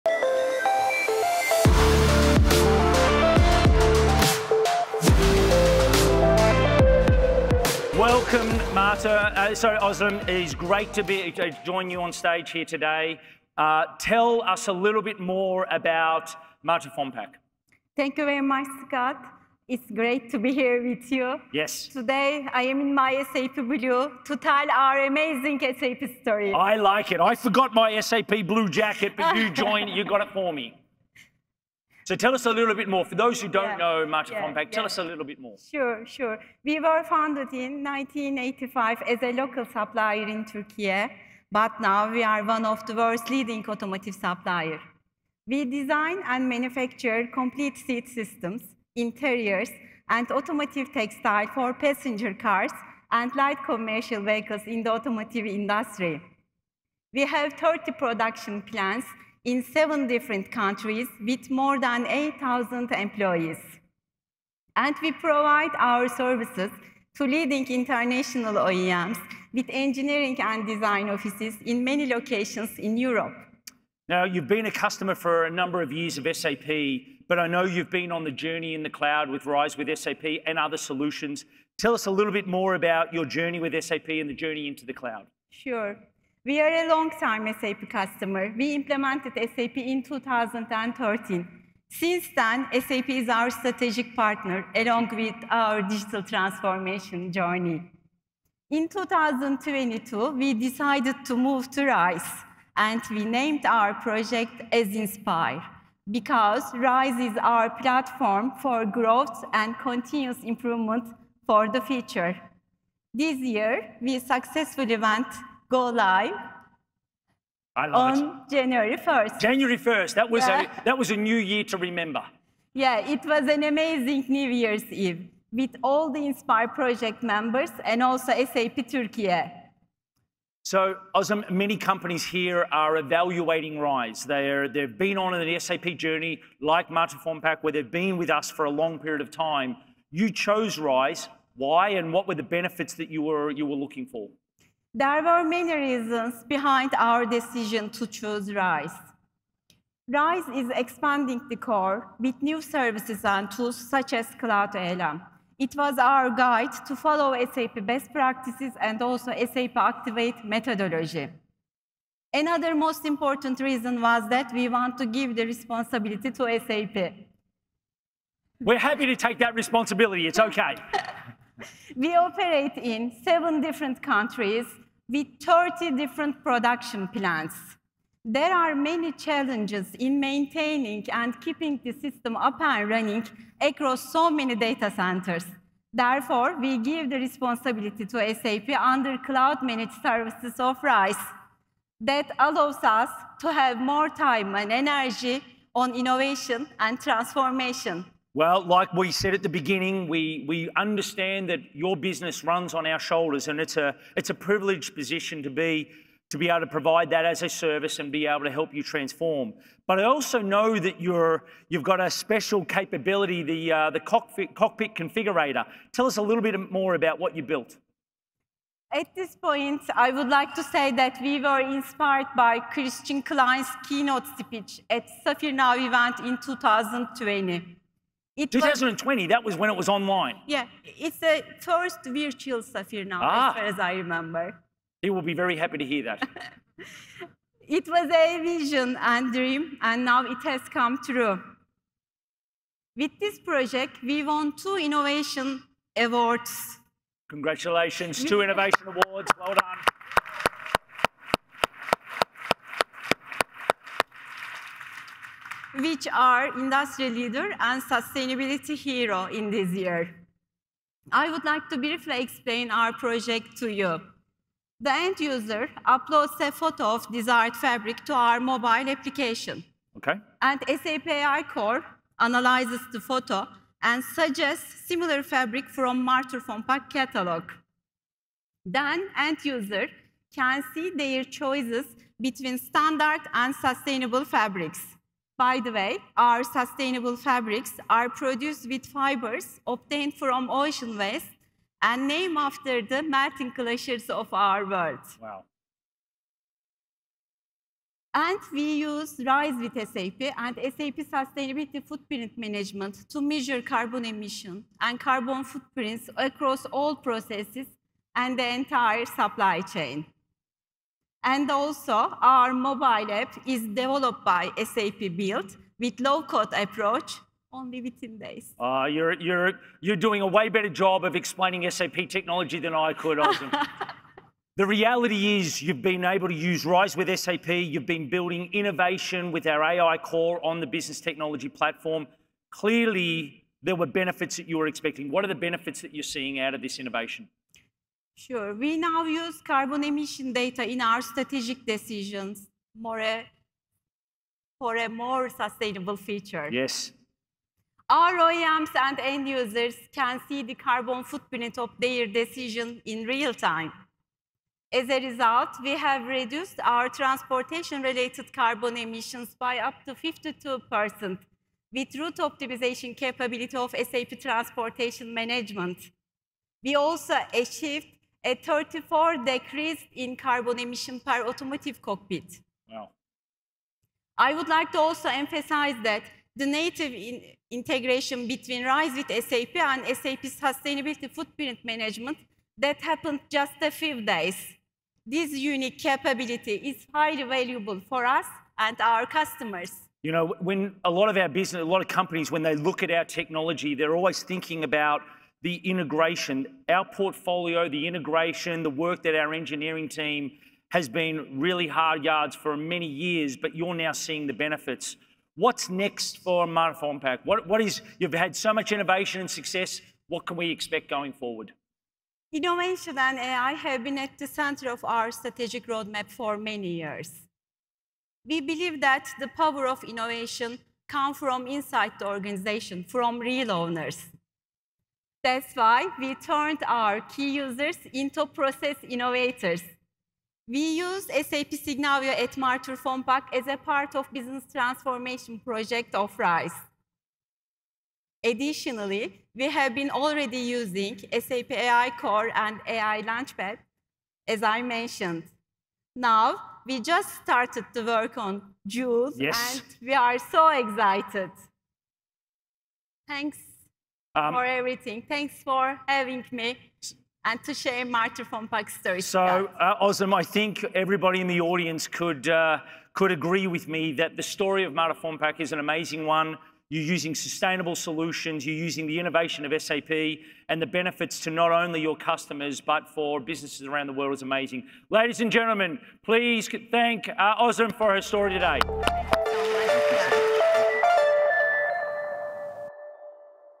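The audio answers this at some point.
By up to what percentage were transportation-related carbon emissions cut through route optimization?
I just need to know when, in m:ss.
5:59.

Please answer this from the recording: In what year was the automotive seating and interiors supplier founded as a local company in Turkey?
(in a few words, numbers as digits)
1985.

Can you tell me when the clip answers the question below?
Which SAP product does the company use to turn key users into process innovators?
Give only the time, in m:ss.
7:11.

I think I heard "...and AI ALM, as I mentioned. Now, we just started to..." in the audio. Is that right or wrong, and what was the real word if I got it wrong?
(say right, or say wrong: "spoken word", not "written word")
wrong: "Launchpad", not "ALM".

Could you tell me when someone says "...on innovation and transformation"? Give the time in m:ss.
3:15.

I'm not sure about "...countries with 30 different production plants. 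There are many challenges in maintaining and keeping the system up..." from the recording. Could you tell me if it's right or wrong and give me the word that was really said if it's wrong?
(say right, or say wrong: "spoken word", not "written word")
right.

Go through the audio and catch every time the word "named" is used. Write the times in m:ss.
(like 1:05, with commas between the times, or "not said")
1:43, 4:52.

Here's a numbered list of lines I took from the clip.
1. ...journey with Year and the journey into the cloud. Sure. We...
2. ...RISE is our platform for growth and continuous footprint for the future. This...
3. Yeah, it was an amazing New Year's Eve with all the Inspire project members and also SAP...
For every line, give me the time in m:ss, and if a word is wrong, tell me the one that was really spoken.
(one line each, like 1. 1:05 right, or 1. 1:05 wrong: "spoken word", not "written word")
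1. 1:23 wrong: "SAP", not "Year"
2. 1:46 wrong: "improvement", not "footprint"
3. 2:02 right.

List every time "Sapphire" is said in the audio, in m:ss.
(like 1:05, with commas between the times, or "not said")
3:45, 3:52.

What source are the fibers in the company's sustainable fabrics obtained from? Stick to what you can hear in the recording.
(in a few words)
Ocean waste.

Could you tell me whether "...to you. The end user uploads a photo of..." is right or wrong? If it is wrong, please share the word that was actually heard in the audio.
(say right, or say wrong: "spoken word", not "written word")
right.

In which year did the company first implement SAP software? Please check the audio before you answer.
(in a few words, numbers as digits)
2013.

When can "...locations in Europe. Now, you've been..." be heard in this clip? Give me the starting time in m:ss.
1:12.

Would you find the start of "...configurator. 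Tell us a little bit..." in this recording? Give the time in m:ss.
3:34.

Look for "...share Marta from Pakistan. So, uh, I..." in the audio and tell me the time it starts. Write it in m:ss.
7:37.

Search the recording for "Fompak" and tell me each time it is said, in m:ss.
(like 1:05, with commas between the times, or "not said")
0:16, 2:17, 4:36, 6:46, 7:12, 7:44.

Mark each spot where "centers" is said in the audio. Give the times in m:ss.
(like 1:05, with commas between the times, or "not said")
3:04, 6:54.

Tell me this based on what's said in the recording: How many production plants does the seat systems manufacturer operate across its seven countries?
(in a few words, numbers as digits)
30.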